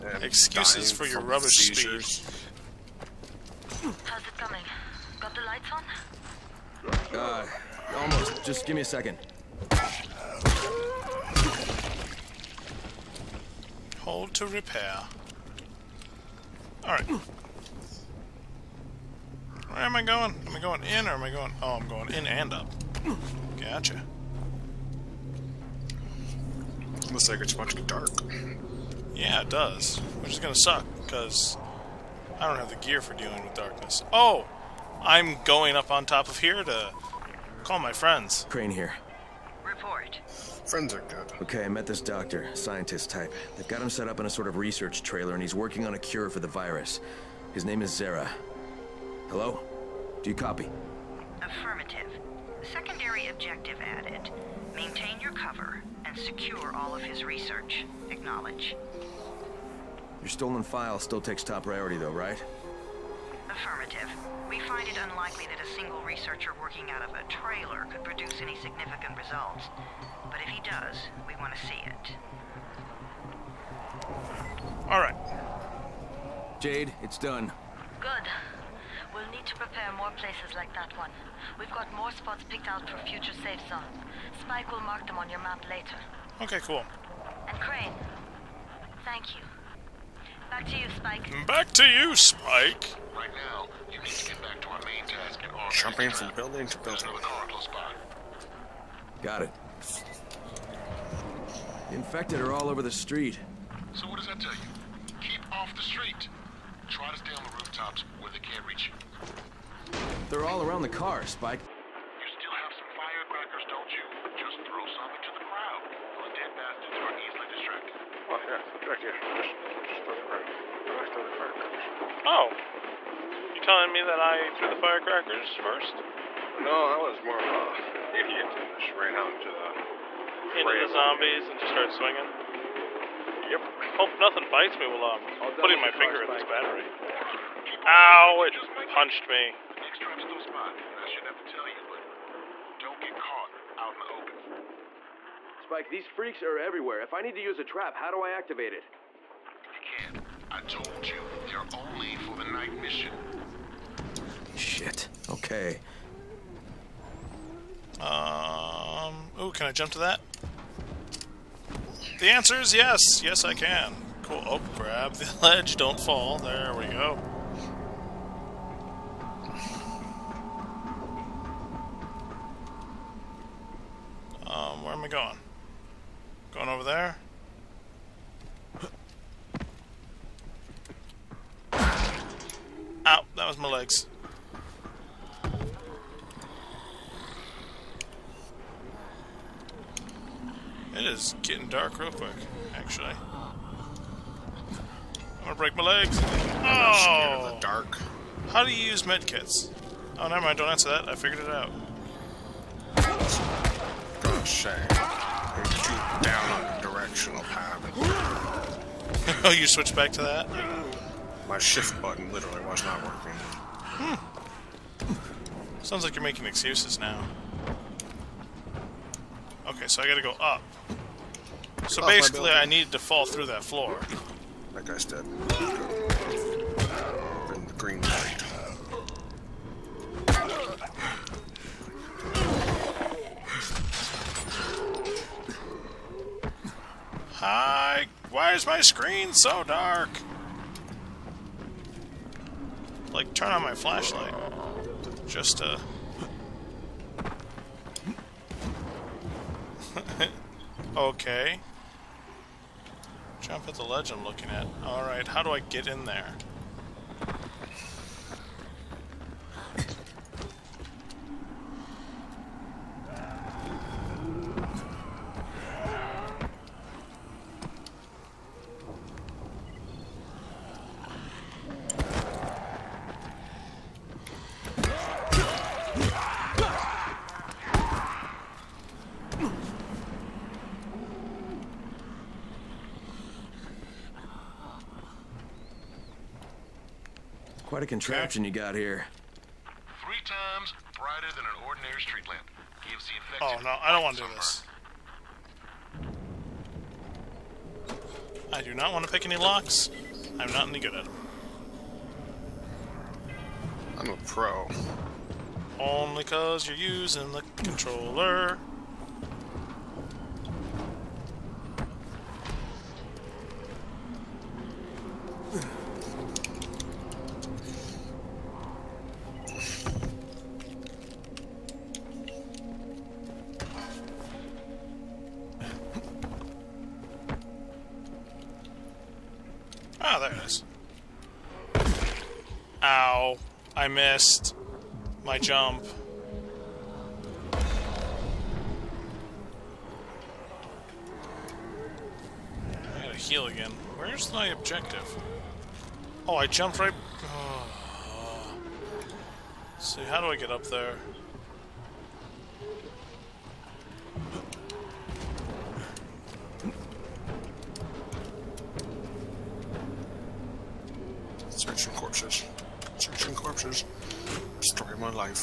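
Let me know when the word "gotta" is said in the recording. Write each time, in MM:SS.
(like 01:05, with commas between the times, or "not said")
03:40, 05:43.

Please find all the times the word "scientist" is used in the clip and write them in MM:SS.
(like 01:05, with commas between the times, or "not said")
00:42.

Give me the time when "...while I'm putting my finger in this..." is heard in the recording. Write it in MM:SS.
02:14.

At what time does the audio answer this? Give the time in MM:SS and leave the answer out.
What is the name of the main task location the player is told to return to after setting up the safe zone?
01:35.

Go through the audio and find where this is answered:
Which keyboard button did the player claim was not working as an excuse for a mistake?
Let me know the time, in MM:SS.
03:31.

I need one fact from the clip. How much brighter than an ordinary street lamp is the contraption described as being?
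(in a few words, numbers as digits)
Three times.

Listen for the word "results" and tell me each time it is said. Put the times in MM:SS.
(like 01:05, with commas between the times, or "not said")
01:09.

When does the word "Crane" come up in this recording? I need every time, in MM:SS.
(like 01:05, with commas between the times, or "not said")
00:38, 01:27.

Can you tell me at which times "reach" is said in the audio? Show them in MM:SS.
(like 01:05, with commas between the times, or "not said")
01:48.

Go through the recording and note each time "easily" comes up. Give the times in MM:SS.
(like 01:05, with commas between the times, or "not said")
01:57.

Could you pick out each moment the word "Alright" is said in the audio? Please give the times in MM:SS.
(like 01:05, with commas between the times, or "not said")
00:16, 04:14.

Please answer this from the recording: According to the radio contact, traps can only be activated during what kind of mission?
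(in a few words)
Night mission.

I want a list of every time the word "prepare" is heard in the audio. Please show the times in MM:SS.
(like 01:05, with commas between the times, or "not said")
01:19.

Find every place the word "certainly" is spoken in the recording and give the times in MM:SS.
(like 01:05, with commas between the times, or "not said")
not said.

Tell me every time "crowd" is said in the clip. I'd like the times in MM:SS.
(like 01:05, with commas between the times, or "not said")
01:55, 02:00.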